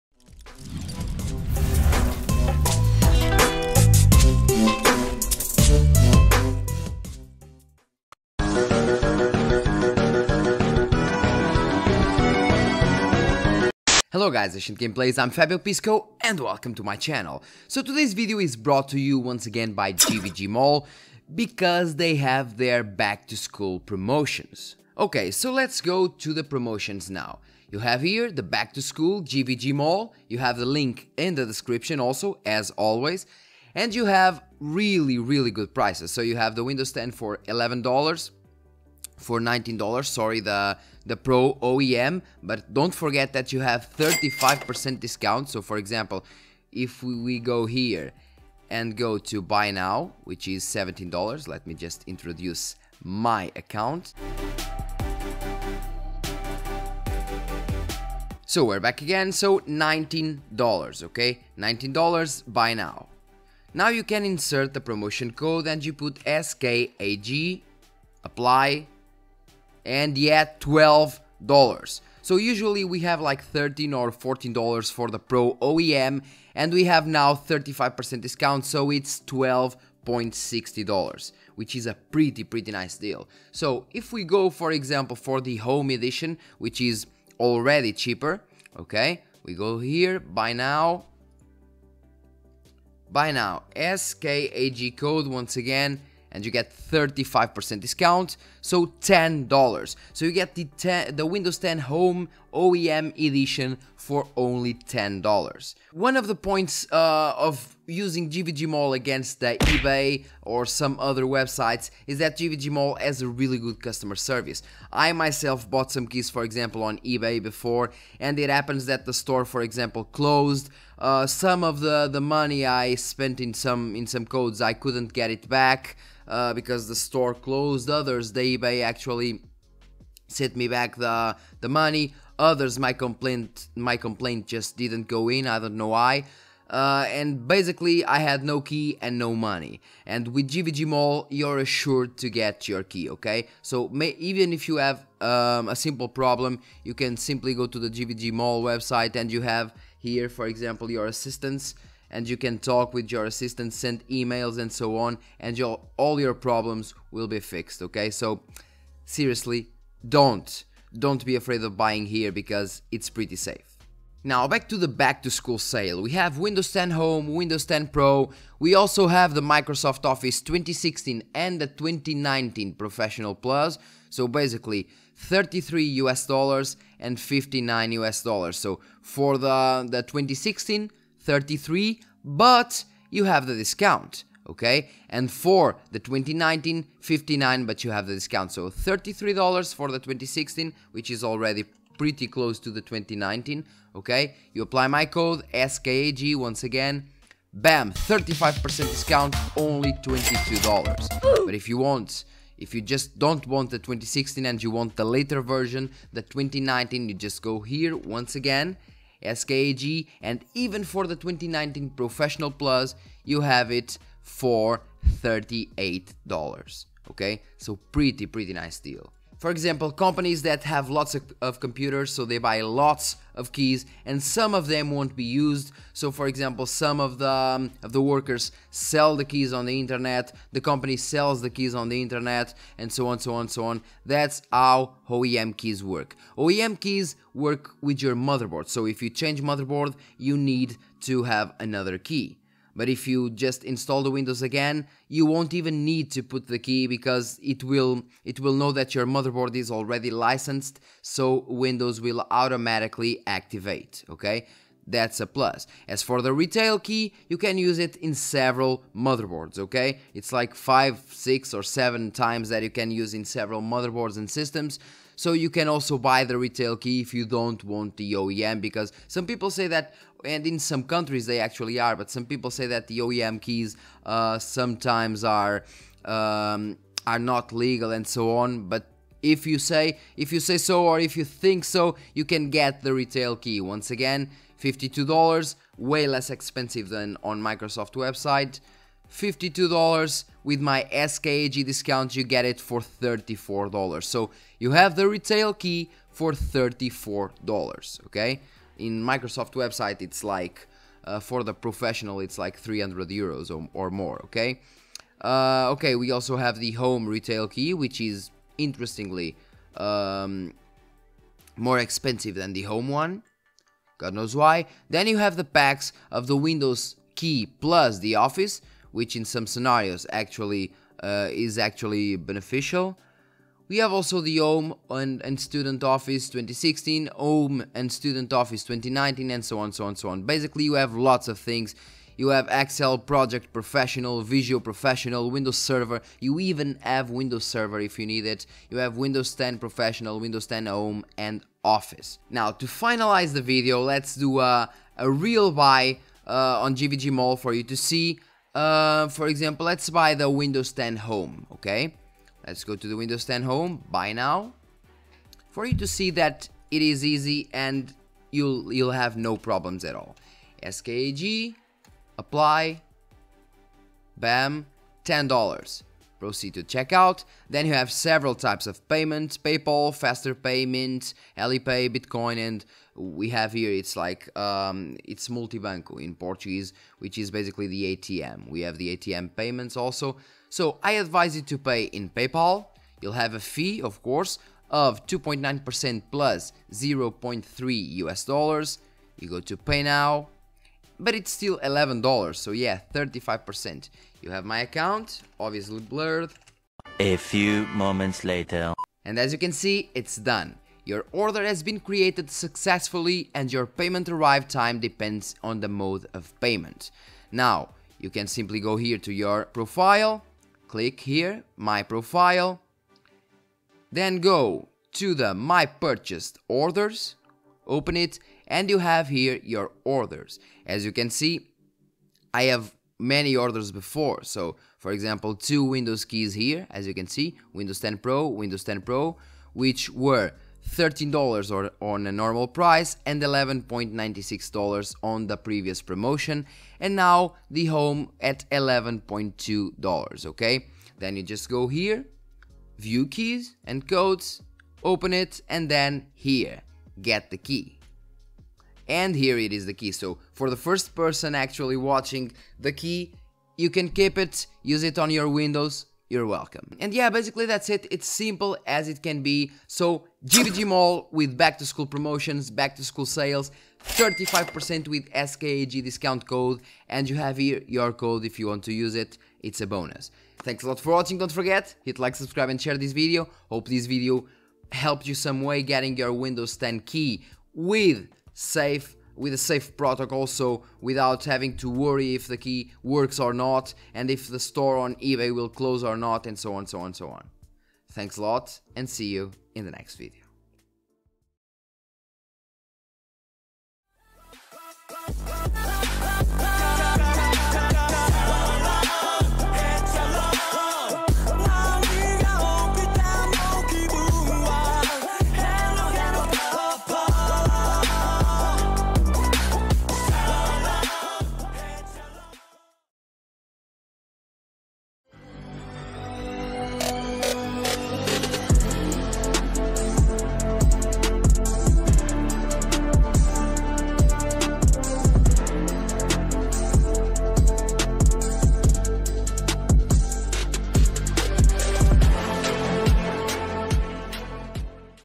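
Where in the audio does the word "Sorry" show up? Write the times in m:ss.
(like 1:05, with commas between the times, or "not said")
0:40.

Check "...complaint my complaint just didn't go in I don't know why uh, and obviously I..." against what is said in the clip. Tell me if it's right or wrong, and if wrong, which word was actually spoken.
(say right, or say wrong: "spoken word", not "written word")
wrong: "basically", not "obviously".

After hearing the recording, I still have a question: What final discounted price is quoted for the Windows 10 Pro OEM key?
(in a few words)
$12.60.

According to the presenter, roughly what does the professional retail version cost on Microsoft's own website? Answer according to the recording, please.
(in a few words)
300 euros.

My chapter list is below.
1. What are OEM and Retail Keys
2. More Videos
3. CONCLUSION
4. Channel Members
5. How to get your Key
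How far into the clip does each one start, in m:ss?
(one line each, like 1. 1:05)
1. 3:39
2. 8:35
3. 7:50
4. 8:13
5. 5:41.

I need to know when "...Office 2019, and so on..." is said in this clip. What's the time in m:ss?
5:28.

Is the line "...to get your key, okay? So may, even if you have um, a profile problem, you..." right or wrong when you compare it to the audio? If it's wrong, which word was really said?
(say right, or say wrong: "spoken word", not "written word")
wrong: "simple", not "profile".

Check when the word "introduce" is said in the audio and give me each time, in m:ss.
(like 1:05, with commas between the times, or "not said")
0:52.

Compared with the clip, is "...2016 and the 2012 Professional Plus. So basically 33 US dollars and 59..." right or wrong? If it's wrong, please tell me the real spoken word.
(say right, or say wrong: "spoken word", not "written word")
wrong: "2019", not "2012".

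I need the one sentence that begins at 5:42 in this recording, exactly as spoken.
Now, to finalize the video, let's do a, a real buy uh, on GVG Mall for you to see.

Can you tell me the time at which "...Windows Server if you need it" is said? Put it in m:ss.
5:37.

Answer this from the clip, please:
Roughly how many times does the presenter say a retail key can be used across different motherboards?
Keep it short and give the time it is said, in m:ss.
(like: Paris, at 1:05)
5, 6 or 7 times, at 4:20.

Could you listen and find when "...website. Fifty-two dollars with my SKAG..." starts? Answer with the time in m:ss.
4:47.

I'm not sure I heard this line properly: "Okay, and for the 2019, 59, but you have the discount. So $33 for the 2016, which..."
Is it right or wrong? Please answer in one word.
right.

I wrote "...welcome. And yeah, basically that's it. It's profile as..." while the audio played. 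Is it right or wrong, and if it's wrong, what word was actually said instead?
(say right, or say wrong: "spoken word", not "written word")
wrong: "simple", not "profile".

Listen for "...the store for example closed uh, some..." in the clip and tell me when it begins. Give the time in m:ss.
1:59.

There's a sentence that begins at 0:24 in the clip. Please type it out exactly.
Okay, so let's go to the promotions now.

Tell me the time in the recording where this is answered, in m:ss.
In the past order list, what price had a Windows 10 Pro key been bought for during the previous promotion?
7:13.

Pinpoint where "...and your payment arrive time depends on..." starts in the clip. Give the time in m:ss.
6:43.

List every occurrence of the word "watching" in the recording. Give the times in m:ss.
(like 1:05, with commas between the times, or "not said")
7:31, 7:50.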